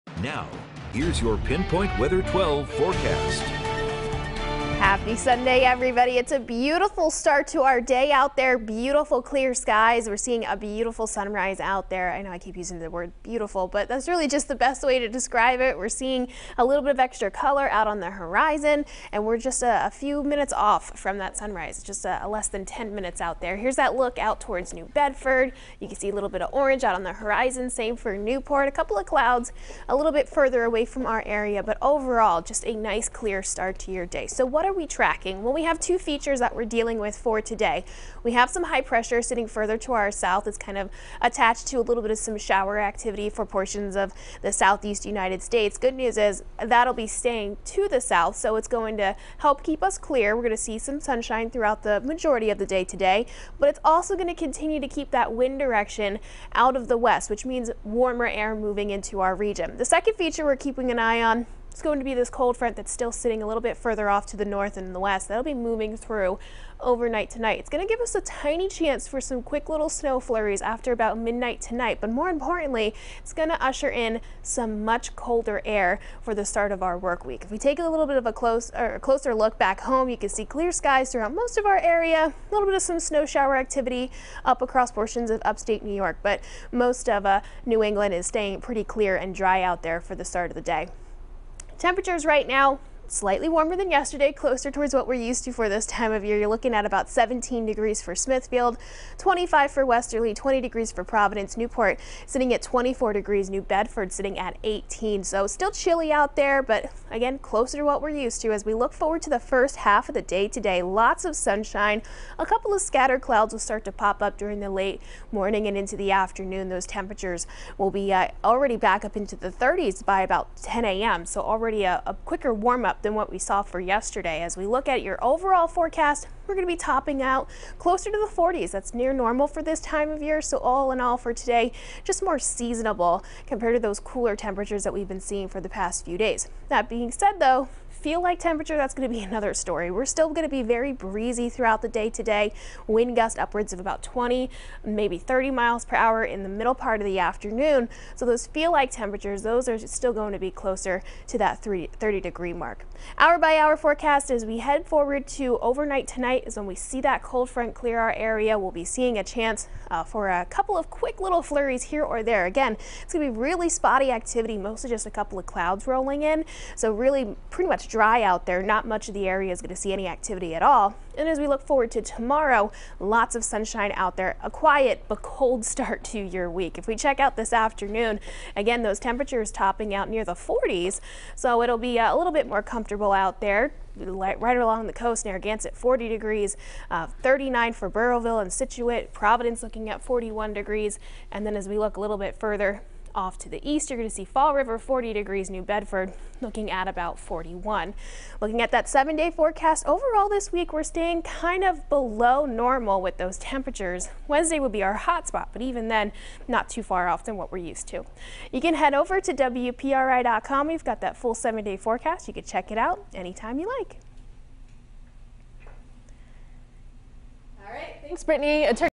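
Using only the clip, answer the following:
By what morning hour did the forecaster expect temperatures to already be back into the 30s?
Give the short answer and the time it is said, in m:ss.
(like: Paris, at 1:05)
10 a.m., at 2:00.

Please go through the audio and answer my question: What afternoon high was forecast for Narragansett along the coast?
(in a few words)
40 degrees.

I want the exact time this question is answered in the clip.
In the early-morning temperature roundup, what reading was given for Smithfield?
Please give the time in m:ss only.
1:37.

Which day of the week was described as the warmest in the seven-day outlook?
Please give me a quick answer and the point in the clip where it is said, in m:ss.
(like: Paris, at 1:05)
Wednesday, at 3:24.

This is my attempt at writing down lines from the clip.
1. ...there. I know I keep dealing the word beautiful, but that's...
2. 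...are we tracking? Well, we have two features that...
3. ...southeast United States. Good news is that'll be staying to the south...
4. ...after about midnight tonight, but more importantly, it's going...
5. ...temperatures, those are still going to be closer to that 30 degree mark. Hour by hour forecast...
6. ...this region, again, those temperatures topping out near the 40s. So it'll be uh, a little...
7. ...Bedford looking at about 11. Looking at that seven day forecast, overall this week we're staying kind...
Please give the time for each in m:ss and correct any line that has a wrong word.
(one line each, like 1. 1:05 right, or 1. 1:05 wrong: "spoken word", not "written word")
1. 0:11 wrong: "using", not "dealing"
2. 0:34 right
3. 0:44 right
4. 1:10 right
5. 2:28 right
6. 2:57 wrong: "afternoon", not "region"
7. 3:15 wrong: "41", not "11".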